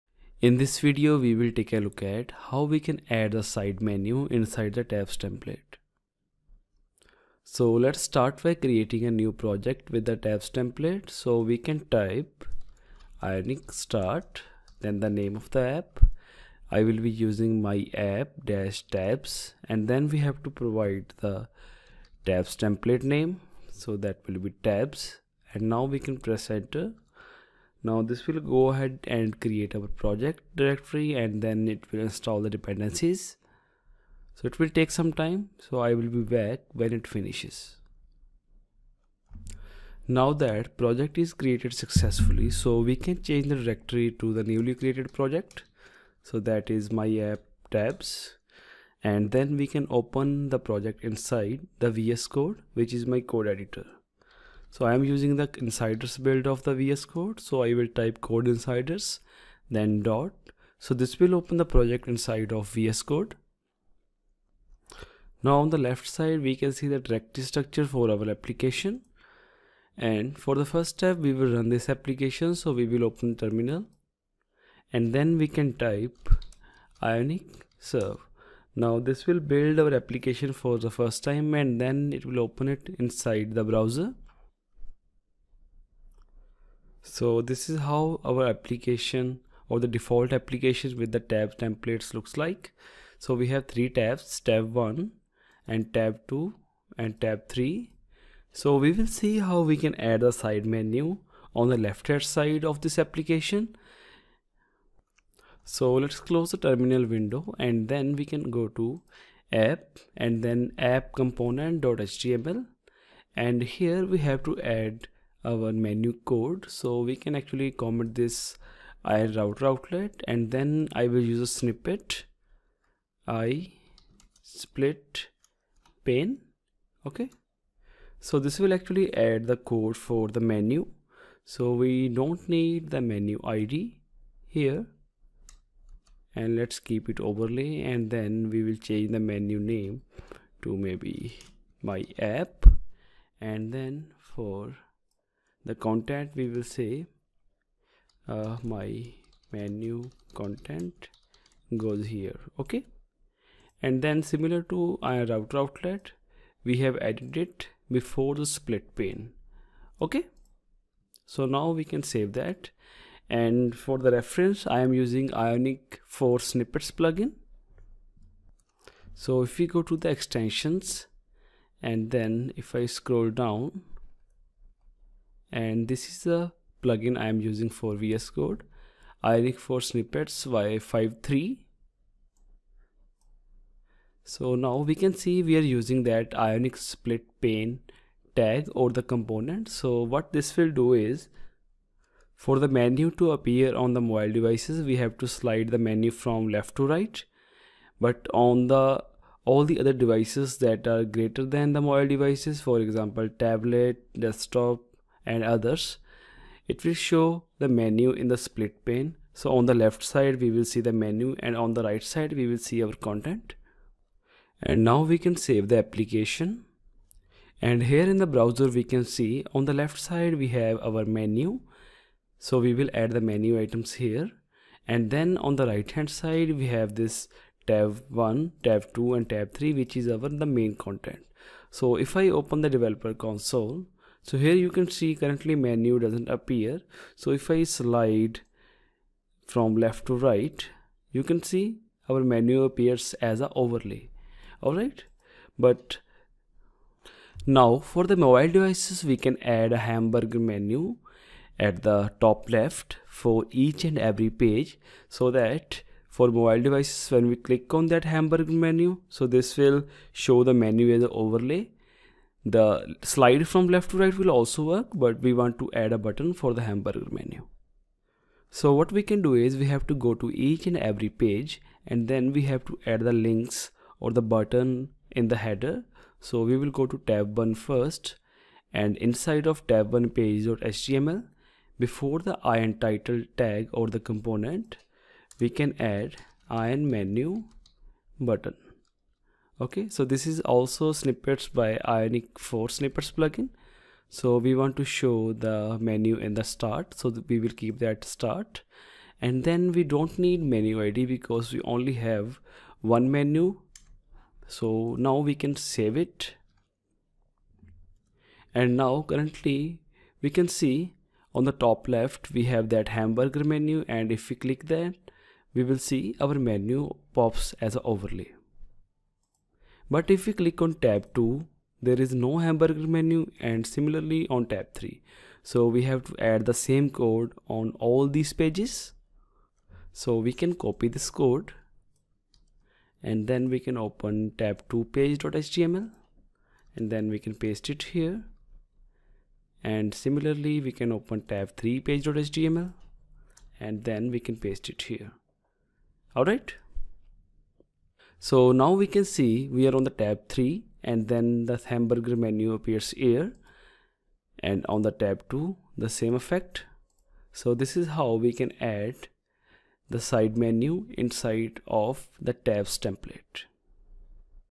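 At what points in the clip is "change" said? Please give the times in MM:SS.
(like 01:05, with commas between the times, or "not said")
00:43, 02:18.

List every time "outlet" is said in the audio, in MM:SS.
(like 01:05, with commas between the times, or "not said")
01:59, 02:35.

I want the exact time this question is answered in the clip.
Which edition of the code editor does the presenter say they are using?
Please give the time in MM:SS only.
00:55.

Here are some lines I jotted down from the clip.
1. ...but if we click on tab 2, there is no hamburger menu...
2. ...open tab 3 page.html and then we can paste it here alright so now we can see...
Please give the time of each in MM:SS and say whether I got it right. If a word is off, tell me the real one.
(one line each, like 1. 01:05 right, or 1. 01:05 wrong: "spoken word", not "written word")
1. 05:19 right
2. 05:40 right.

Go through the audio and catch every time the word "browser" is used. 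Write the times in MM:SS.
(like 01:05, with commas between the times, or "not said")
01:23, 03:38.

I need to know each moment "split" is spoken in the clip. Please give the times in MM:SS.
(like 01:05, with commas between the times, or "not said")
02:04, 02:38, 03:06, 03:28.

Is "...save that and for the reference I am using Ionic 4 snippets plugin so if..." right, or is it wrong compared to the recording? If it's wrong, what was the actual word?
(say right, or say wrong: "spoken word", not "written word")
right.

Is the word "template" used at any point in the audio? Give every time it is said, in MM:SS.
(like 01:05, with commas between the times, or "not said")
00:05, 00:10, 00:22, 01:31, 06:02.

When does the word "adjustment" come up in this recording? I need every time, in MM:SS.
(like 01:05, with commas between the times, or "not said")
not said.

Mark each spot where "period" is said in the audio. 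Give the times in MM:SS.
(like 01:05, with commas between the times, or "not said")
not said.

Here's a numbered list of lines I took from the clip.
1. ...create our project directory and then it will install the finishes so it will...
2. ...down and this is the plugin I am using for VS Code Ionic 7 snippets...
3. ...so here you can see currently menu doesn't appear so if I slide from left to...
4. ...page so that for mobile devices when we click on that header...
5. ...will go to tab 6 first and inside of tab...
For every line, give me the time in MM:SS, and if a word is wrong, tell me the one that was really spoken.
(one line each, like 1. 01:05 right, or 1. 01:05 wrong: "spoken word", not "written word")
1. 00:29 wrong: "dependencies", not "finishes"
2. 02:53 wrong: "4", not "7"
3. 03:54 right
4. 04:14 wrong: "hamburger", not "header"
5. 04:36 wrong: "1", not "6".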